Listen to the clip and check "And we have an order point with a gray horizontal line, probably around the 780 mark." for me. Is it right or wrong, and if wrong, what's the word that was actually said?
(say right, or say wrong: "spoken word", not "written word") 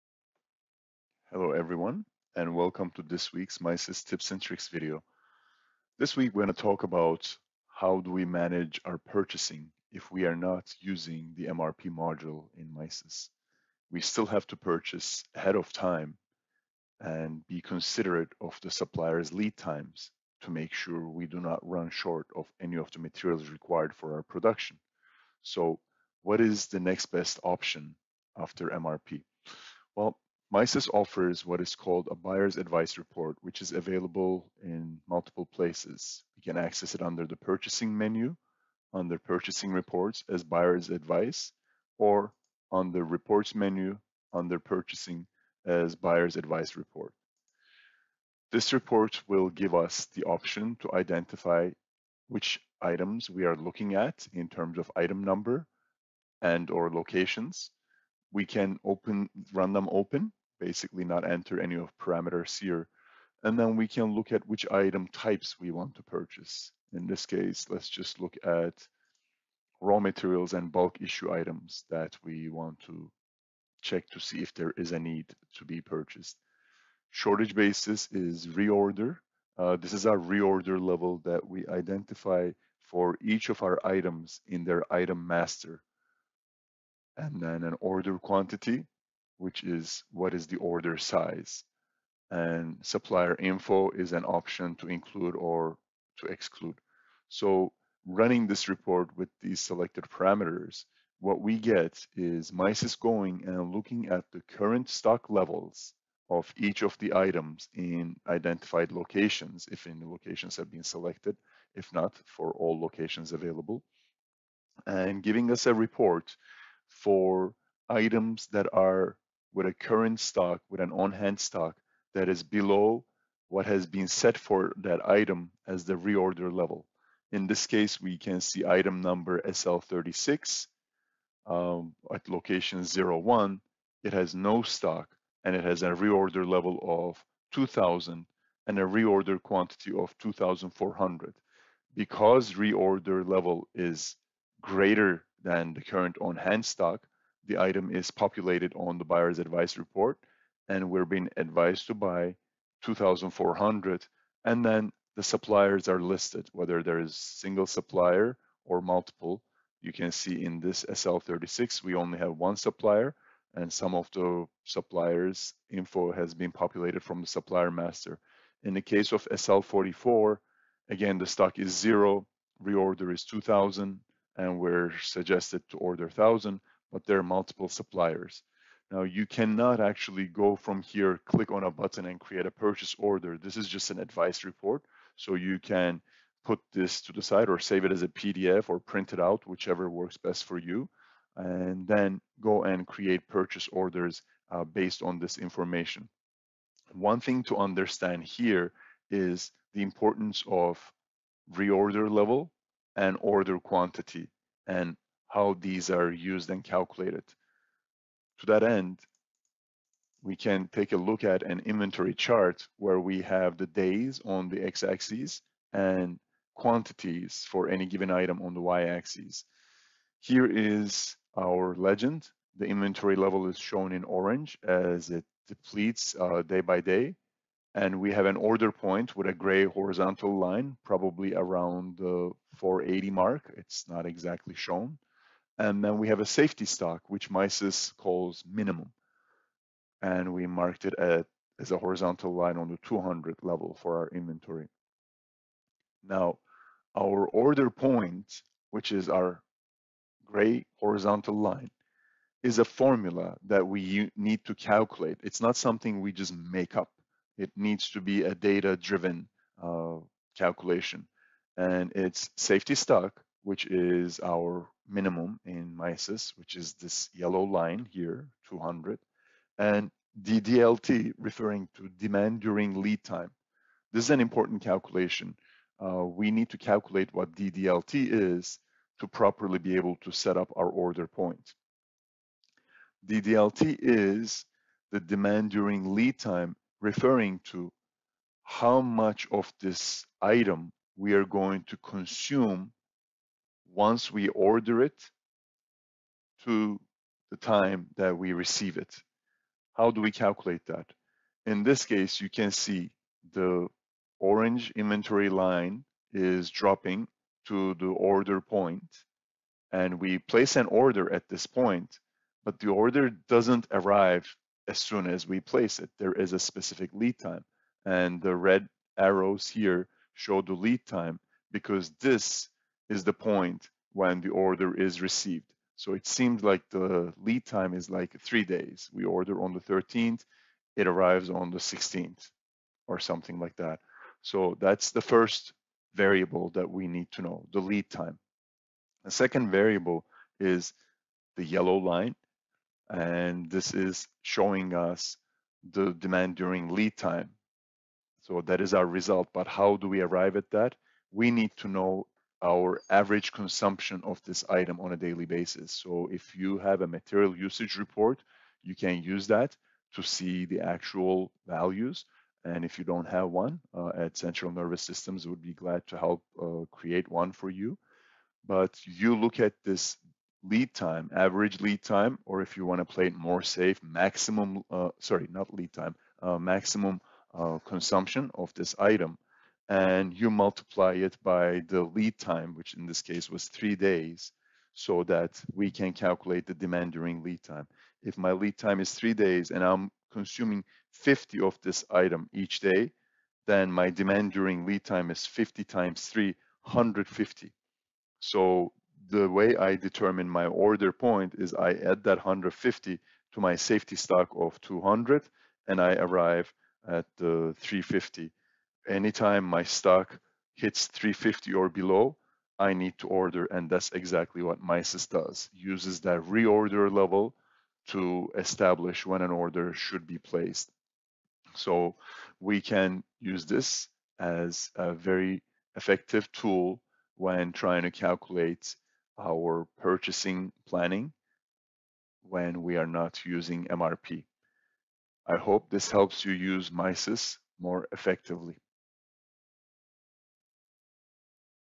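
wrong: "480", not "780".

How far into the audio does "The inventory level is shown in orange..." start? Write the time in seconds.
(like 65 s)
222 s.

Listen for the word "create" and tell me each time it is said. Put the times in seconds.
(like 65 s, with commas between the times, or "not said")
182 s, 192 s, 366 s.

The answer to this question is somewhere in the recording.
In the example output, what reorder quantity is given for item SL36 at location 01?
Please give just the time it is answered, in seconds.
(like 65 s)
138 s.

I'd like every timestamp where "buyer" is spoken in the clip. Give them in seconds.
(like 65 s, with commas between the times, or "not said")
32 s, 40 s, 45 s, 149 s.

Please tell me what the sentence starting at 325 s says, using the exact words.
So it seemed like the lead time is like three days.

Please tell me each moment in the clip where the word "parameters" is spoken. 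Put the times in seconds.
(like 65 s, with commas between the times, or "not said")
61 s, 100 s.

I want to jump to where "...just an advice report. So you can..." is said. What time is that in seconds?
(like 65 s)
183 s.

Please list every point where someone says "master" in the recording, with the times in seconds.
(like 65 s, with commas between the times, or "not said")
85 s, 167 s.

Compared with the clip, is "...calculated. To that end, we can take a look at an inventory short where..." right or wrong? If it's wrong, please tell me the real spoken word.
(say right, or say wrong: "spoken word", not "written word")
wrong: "chart", not "short".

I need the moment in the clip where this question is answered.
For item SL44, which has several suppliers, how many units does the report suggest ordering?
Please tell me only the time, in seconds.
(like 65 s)
176 s.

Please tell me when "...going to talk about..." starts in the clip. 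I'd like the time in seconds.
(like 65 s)
6 s.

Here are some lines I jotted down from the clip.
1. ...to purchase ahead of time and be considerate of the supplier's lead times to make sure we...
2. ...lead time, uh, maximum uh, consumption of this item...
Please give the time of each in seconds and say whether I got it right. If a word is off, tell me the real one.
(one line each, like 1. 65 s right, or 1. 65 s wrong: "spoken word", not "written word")
1. 14 s right
2. 375 s right.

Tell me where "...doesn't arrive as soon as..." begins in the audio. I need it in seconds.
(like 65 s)
313 s.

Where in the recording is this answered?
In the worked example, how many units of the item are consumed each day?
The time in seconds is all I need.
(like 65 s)
390 s.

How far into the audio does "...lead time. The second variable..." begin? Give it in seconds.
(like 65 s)
337 s.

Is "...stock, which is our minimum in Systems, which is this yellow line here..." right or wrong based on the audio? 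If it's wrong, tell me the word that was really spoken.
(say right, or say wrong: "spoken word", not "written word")
wrong: "MISys", not "Systems".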